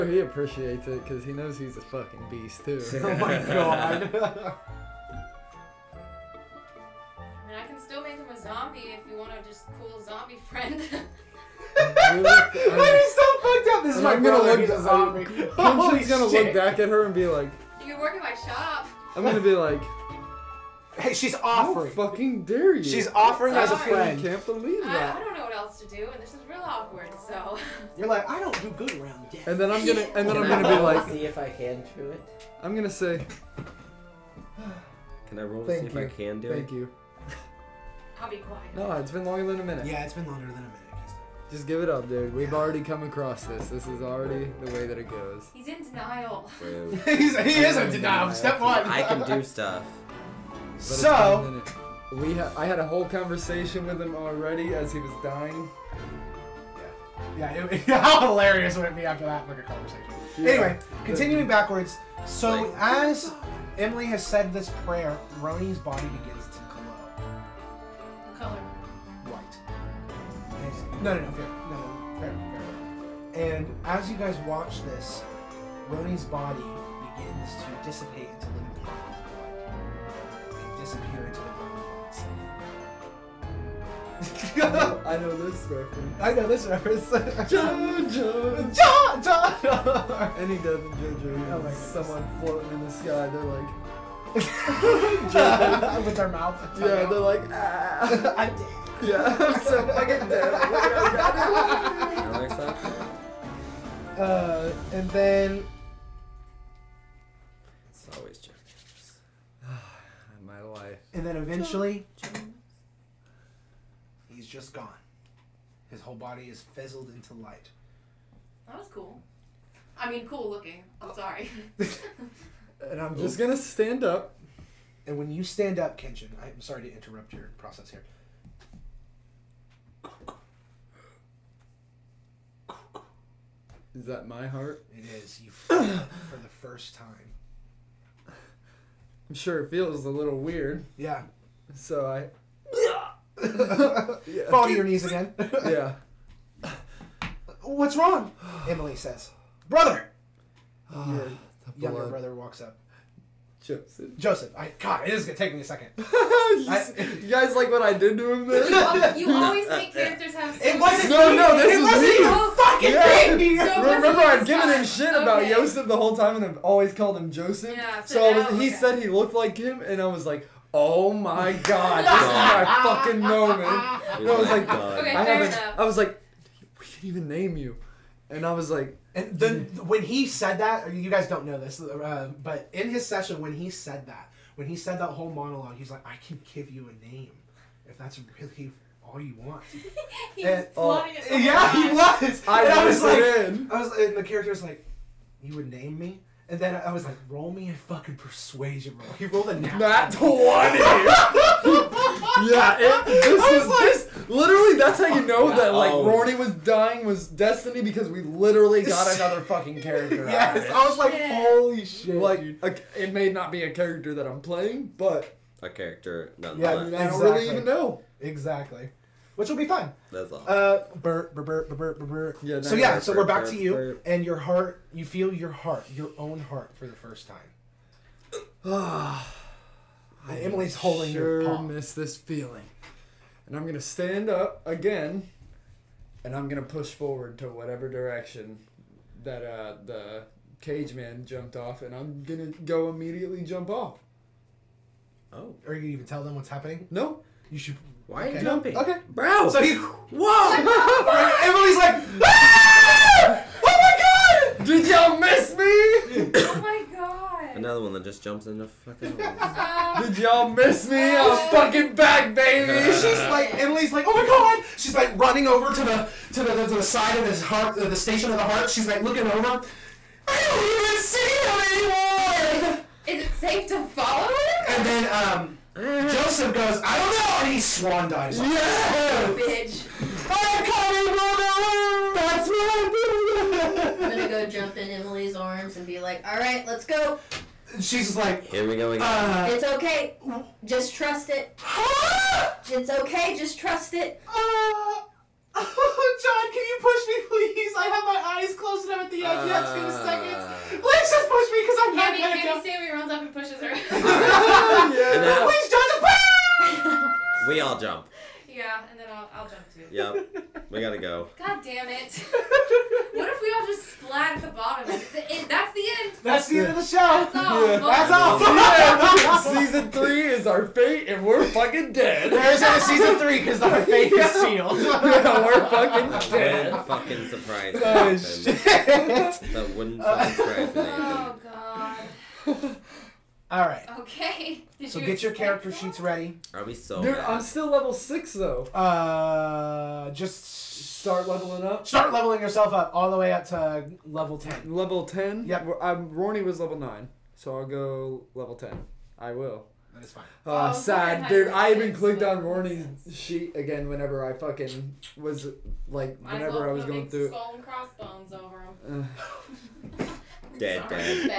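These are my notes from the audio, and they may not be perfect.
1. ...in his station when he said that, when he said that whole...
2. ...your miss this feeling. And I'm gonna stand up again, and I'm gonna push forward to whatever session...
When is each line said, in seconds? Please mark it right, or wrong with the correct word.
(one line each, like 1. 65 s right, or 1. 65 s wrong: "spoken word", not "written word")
1. 182 s wrong: "session", not "station"
2. 231 s wrong: "direction", not "session".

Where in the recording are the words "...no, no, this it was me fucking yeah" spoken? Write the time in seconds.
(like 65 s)
161 s.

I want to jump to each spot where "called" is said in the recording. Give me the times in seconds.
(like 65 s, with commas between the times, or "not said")
166 s.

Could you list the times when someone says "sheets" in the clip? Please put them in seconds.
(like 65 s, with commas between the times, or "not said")
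335 s, 353 s.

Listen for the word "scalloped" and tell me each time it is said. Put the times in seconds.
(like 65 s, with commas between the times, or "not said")
not said.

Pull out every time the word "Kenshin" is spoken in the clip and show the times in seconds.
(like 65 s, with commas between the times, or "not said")
125 s.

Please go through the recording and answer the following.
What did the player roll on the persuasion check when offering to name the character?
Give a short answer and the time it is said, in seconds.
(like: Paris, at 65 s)
Nat 20, at 199 s.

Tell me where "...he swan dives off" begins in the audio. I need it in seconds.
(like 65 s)
277 s.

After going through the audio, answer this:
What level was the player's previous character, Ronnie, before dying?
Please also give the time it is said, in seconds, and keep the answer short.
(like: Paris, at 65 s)
9, at 346 s.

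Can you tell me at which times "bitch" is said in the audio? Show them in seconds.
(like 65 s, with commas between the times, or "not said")
279 s.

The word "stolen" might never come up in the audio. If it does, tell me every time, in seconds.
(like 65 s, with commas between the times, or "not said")
not said.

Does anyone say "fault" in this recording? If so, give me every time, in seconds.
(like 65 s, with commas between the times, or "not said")
not said.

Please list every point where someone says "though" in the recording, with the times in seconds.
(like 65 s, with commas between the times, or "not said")
338 s.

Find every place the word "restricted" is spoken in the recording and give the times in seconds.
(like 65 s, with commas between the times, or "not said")
not said.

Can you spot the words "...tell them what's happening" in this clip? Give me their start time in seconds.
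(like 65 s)
246 s.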